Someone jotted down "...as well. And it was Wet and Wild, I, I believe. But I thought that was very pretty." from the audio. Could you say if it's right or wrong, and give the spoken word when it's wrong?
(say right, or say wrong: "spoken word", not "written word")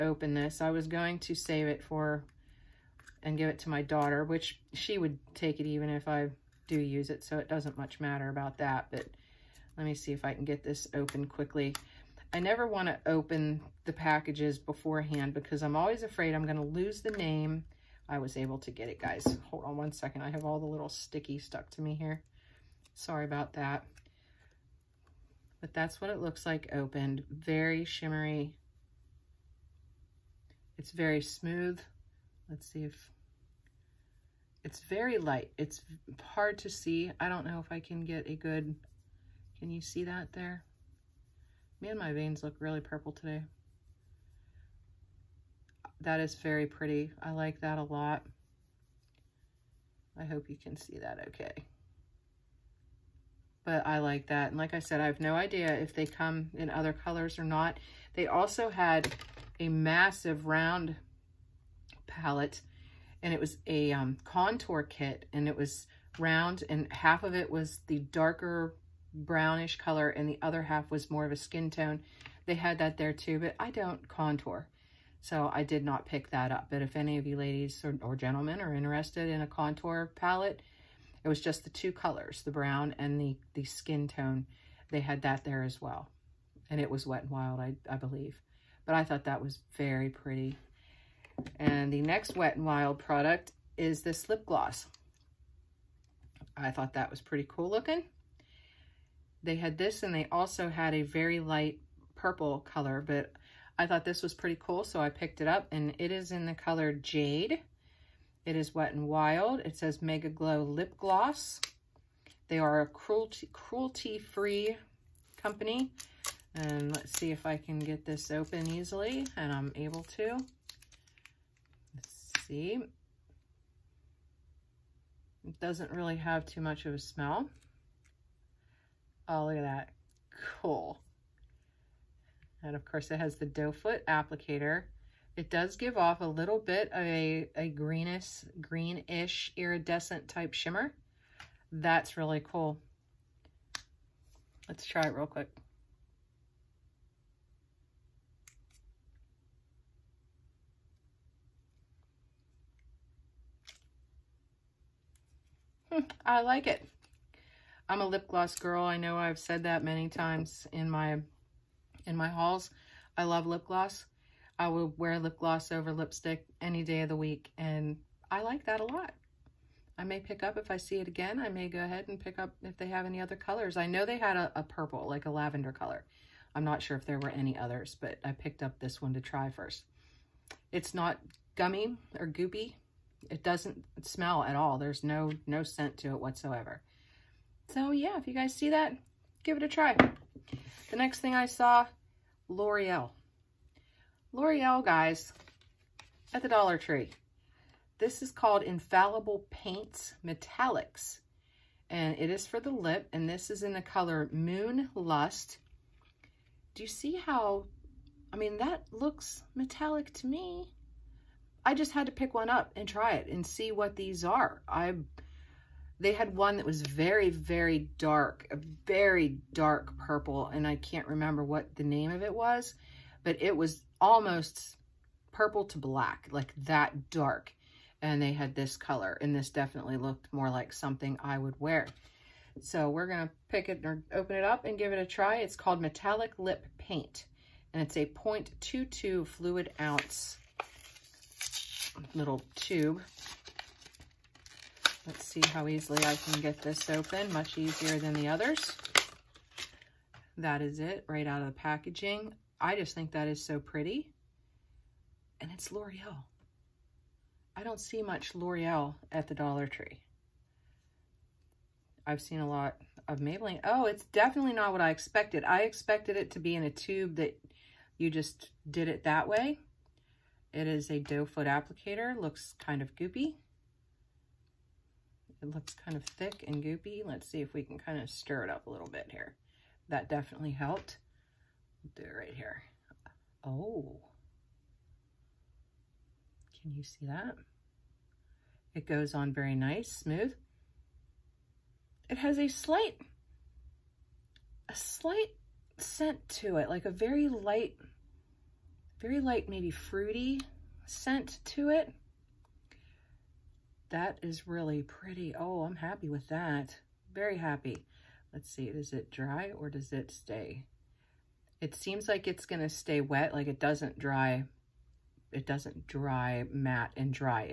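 right.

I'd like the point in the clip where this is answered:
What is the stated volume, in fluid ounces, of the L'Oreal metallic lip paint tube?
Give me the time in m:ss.
3:58.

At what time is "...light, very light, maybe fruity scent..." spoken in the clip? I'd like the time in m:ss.
4:57.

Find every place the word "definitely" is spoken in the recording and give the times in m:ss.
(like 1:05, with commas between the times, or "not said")
3:49, 4:24, 4:40.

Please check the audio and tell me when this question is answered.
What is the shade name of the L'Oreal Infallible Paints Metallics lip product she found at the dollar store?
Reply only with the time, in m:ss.
3:24.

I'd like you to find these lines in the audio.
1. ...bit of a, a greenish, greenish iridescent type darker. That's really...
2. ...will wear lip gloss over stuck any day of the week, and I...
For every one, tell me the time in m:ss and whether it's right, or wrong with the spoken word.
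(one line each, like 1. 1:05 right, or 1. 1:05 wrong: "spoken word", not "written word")
1. 2:16 wrong: "shimmer", not "darker"
2. 2:44 wrong: "lipstick", not "stuck".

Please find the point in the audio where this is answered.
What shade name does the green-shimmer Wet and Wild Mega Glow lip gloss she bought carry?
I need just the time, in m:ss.
1:46.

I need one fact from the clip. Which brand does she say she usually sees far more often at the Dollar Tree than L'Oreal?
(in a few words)
Maybelline.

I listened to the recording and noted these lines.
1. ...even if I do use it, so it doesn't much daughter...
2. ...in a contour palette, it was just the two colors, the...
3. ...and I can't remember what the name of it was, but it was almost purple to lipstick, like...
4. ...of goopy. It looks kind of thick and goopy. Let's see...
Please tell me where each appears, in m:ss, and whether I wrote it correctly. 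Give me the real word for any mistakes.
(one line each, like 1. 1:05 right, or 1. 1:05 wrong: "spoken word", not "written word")
1. 0:05 wrong: "matter", not "daughter"
2. 1:19 right
3. 3:40 wrong: "black", not "lipstick"
4. 4:32 right.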